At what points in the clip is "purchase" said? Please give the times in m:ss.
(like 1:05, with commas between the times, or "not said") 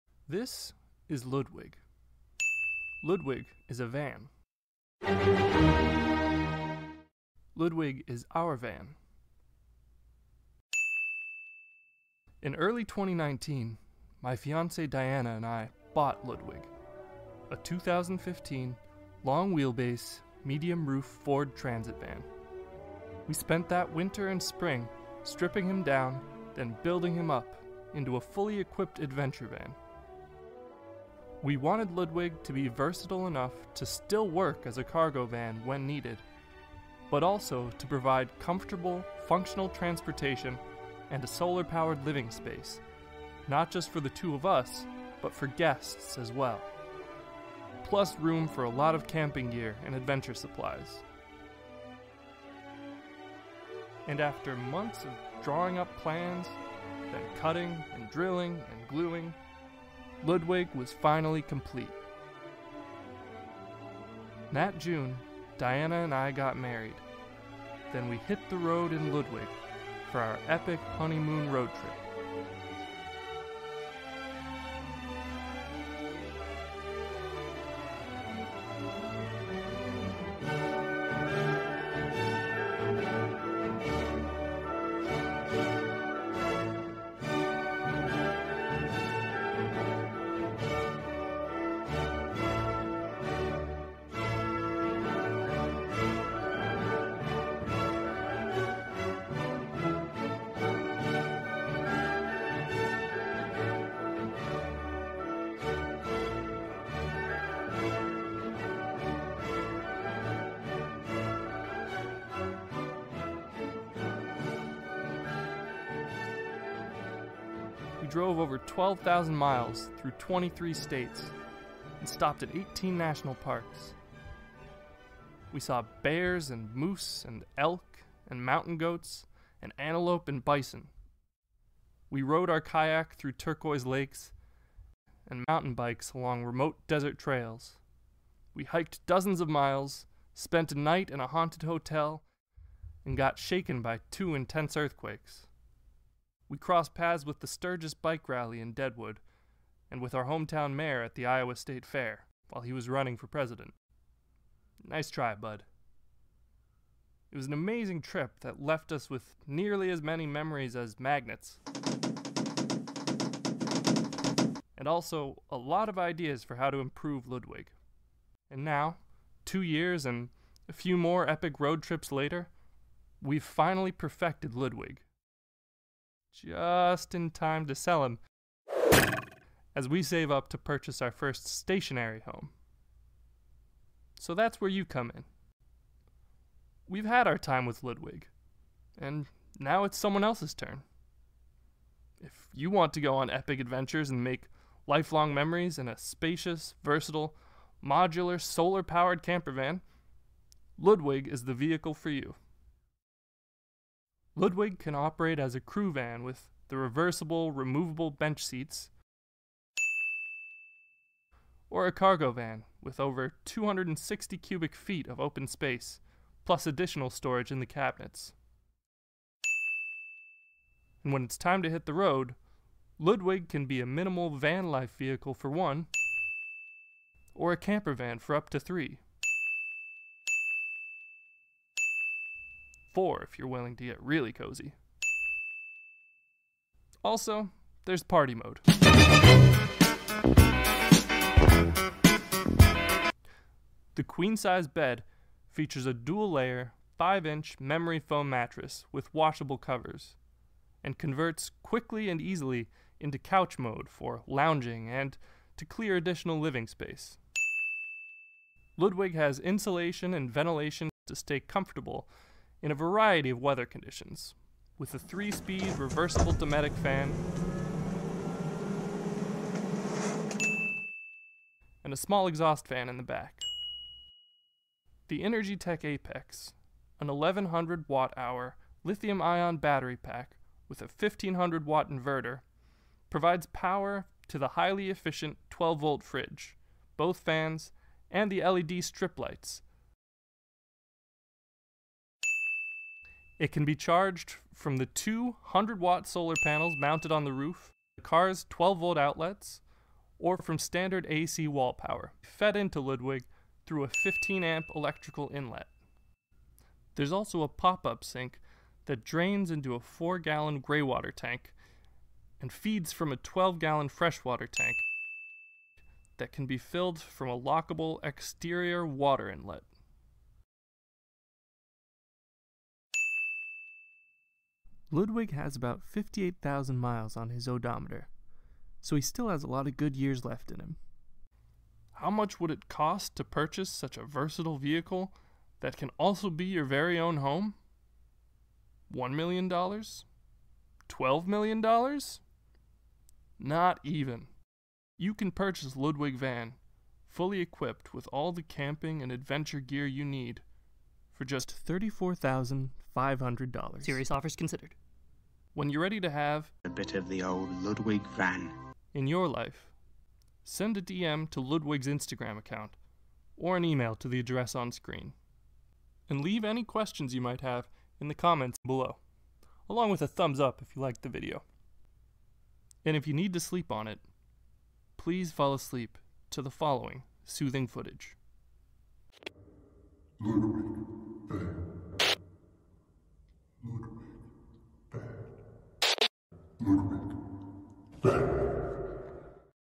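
3:00, 5:33, 5:45.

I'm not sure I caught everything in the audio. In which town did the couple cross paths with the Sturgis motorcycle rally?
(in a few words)
Deadwood.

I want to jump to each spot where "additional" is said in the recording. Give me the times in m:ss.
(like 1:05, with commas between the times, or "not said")
3:36, 4:15.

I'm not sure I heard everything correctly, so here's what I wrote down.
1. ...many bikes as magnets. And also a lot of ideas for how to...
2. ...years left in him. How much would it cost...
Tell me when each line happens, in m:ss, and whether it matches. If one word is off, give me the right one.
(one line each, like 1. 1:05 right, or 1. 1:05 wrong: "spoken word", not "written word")
1. 2:40 wrong: "memories", not "bikes"
2. 5:29 right.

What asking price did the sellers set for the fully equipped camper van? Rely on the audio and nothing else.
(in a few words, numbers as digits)
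$34,500.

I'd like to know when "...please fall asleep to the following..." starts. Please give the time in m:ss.
6:14.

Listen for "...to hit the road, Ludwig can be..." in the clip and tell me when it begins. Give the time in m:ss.
3:41.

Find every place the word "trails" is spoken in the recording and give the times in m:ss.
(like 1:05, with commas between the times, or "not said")
2:17.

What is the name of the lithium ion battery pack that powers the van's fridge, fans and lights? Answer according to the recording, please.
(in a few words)
Energy Tech Apex.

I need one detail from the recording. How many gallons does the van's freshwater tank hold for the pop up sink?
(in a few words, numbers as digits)
12 gallons.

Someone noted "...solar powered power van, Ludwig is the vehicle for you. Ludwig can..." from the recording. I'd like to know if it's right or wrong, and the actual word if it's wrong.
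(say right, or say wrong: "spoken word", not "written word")
wrong: "camper", not "power".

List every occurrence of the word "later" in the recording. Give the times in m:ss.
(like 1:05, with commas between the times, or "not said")
2:52.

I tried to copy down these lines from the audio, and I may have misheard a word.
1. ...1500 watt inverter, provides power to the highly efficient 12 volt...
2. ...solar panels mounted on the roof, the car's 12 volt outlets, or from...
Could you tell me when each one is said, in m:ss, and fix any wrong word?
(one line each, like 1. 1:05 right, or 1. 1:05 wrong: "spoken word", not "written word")
1. 4:40 right
2. 4:56 right.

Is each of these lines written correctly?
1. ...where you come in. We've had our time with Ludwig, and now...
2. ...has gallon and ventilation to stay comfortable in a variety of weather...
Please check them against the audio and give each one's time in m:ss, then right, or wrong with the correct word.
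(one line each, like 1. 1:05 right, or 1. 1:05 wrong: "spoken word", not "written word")
1. 3:04 right
2. 4:19 wrong: "insulation", not "gallon".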